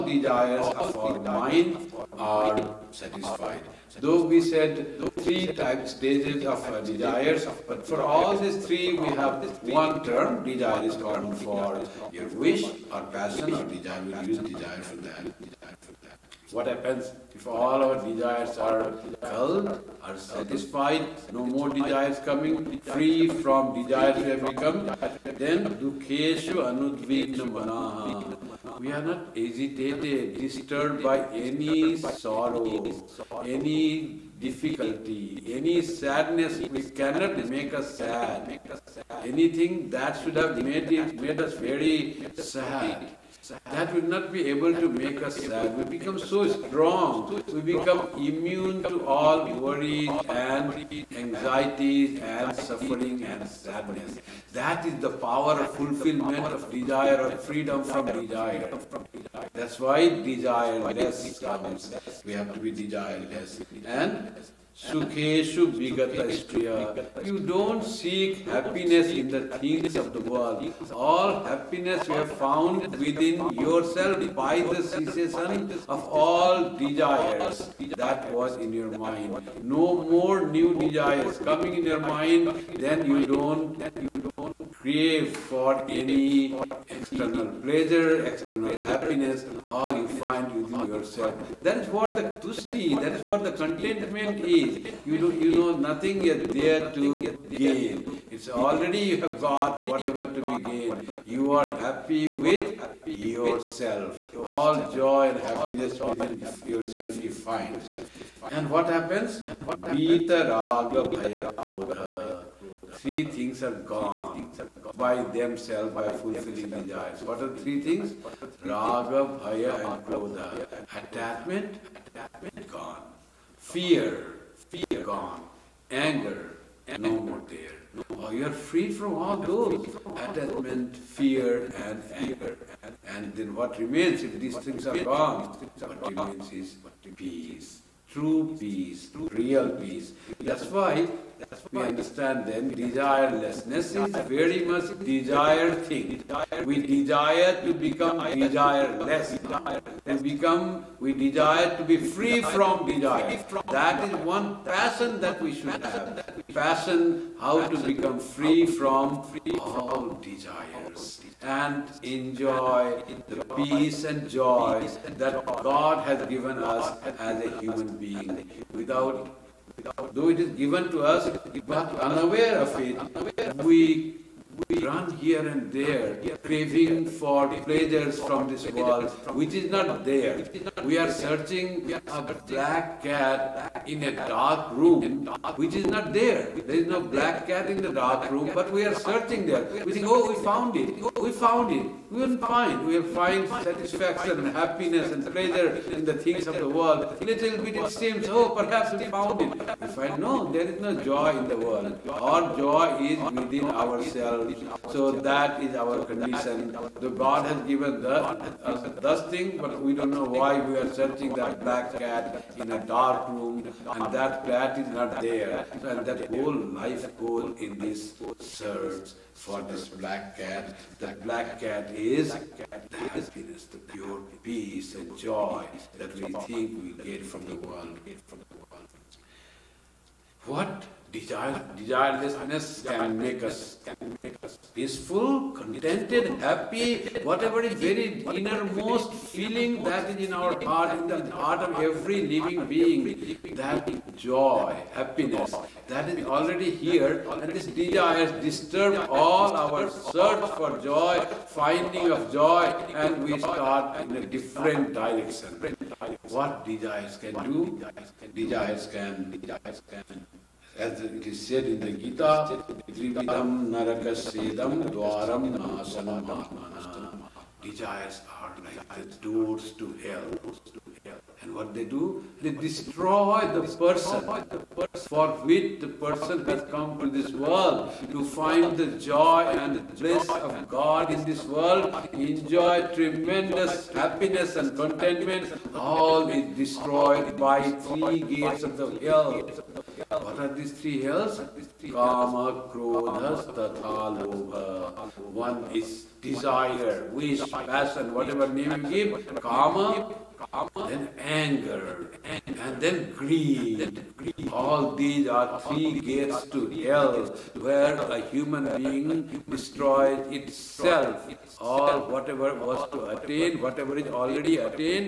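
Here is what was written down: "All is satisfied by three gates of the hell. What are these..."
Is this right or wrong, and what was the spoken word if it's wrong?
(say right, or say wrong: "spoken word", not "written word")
wrong: "destroyed", not "satisfied".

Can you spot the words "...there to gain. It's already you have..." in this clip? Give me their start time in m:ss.
1:36.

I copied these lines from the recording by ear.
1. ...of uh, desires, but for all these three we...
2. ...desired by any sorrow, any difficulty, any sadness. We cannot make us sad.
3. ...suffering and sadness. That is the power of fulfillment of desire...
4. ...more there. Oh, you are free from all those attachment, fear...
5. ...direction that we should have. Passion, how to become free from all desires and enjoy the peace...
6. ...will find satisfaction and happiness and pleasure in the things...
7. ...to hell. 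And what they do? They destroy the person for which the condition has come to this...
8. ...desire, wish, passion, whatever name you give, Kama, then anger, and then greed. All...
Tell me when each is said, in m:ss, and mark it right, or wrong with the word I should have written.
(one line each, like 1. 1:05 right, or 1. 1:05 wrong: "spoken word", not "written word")
1. 0:06 right
2. 0:30 wrong: "disturbed", not "desired"
3. 0:52 right
4. 2:07 right
5. 2:34 wrong: "passion", not "direction"
6. 3:12 right
7. 4:29 wrong: "person", not "condition"
8. 4:56 right.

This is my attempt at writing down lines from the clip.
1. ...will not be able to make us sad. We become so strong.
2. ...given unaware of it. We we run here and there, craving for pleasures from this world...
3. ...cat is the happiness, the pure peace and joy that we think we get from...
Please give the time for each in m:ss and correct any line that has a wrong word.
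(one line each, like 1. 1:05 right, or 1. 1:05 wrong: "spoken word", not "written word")
1. 0:43 right
2. 2:51 right
3. 3:41 right.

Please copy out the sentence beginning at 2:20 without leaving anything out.
That's why that's what we understand then.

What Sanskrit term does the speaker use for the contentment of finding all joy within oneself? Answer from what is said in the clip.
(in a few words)
tusti.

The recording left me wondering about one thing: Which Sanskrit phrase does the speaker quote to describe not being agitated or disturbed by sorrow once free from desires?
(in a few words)
dukeshu anudvigna manaha.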